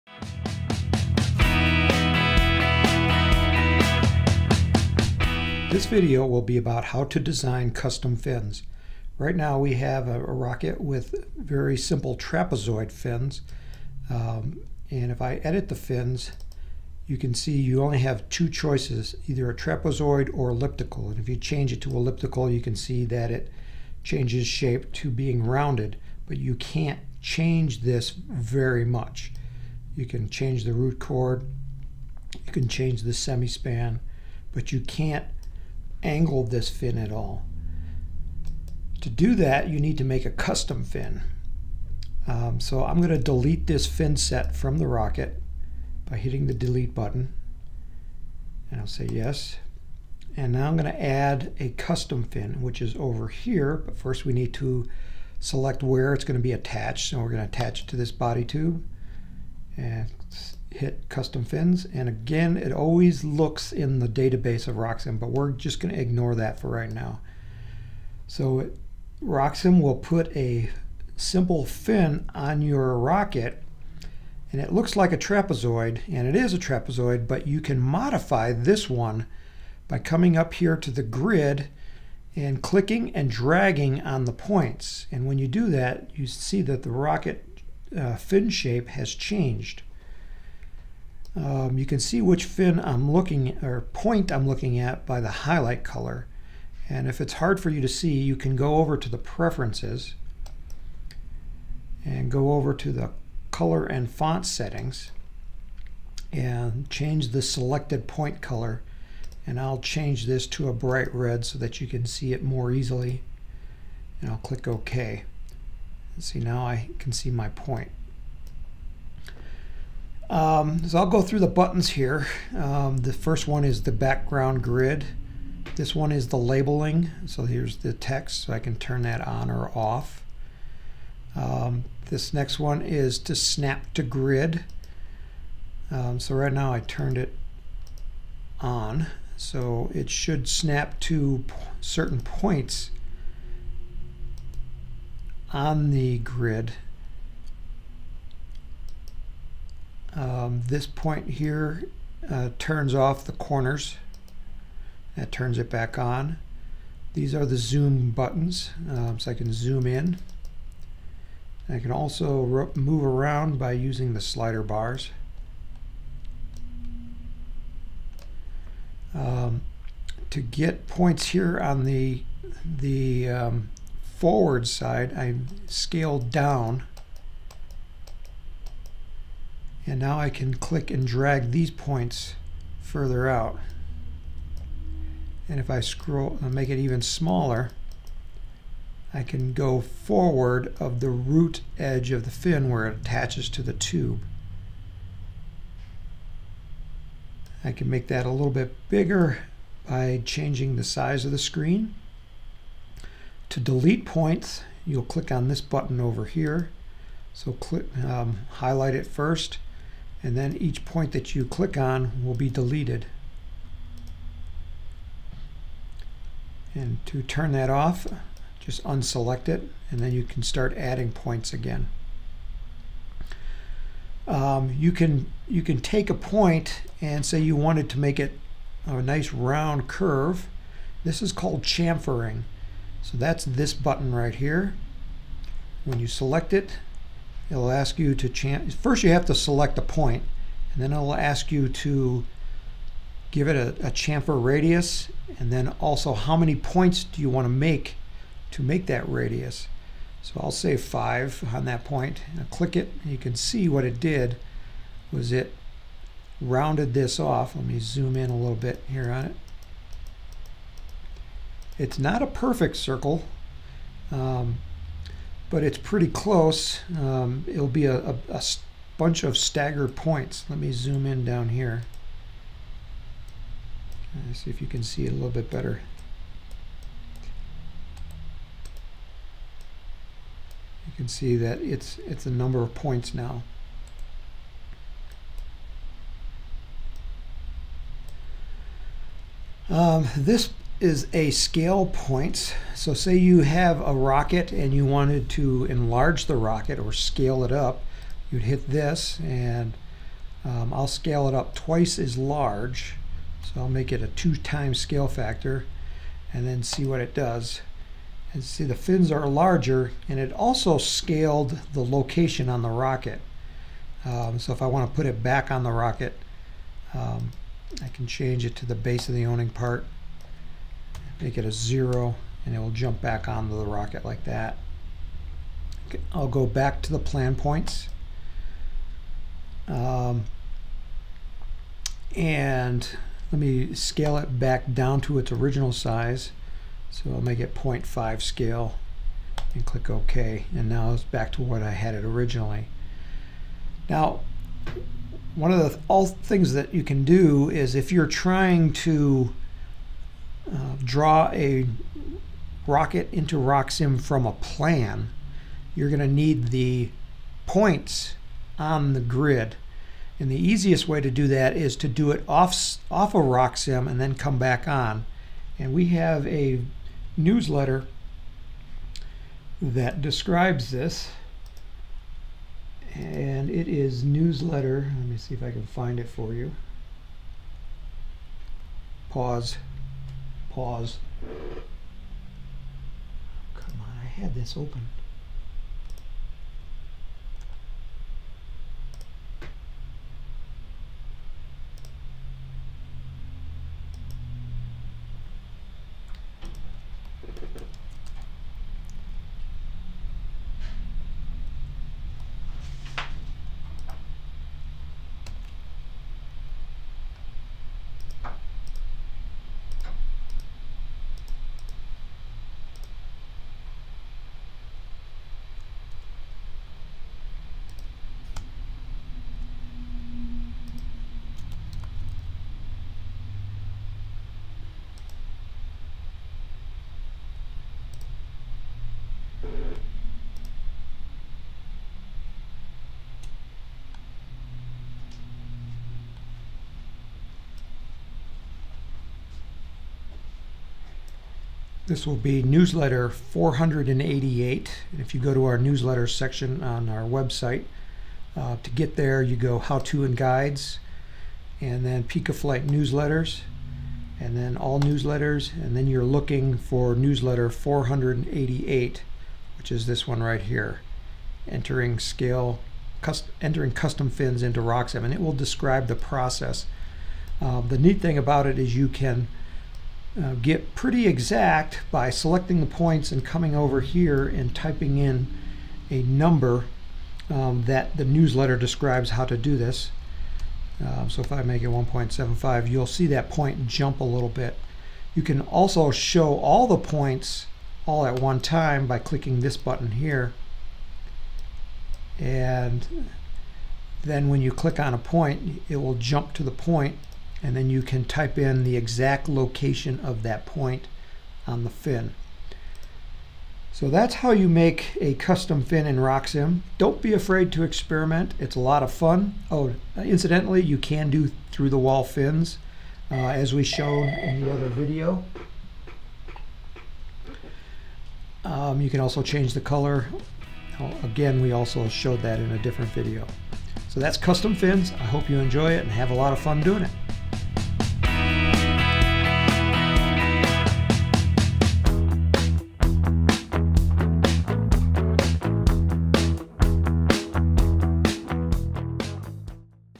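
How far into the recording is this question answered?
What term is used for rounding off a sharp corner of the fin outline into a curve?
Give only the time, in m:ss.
3:51.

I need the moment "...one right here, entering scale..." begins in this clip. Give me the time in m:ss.
7:40.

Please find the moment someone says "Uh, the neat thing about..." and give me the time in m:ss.
7:47.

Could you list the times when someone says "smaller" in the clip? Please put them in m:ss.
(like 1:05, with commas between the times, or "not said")
3:07.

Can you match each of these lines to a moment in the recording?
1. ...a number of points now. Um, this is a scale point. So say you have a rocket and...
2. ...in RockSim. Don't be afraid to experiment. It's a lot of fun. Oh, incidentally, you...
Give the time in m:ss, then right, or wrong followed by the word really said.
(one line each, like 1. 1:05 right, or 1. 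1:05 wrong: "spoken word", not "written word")
1. 4:42 right
2. 8:25 right.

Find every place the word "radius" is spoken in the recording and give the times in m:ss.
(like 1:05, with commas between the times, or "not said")
4:04, 4:09.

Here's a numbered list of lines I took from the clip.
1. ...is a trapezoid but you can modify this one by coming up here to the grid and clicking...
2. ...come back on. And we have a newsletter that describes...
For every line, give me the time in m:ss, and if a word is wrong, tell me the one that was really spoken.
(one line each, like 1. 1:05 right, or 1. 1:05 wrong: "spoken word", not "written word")
1. 1:16 right
2. 6:04 right.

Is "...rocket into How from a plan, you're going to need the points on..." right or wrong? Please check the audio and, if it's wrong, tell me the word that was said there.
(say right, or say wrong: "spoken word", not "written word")
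wrong: "RockSim", not "How".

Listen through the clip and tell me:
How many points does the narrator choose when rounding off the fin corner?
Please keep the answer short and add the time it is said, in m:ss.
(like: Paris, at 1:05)
5, at 4:10.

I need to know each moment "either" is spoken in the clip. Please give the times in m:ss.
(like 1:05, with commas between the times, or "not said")
0:19.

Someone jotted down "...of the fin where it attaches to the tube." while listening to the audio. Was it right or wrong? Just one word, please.
right.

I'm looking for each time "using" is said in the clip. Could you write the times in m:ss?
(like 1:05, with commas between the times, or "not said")
2:43.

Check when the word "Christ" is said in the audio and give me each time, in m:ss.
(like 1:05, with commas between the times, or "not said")
not said.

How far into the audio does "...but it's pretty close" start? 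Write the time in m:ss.
4:25.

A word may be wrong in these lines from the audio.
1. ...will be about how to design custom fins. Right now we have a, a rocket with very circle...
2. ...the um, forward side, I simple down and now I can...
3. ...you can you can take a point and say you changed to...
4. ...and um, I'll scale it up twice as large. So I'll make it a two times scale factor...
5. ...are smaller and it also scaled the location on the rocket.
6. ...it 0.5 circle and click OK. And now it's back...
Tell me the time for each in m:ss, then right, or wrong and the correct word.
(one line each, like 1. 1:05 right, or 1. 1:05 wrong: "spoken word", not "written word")
1. 0:06 wrong: "simple", not "circle"
2. 2:52 wrong: "scale", not "simple"
3. 3:44 wrong: "wanted", not "changed"
4. 4:59 right
5. 5:09 wrong: "larger", not "smaller"
6. 5:37 wrong: "scale", not "circle".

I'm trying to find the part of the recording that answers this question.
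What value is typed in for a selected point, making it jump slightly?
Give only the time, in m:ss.
8:01.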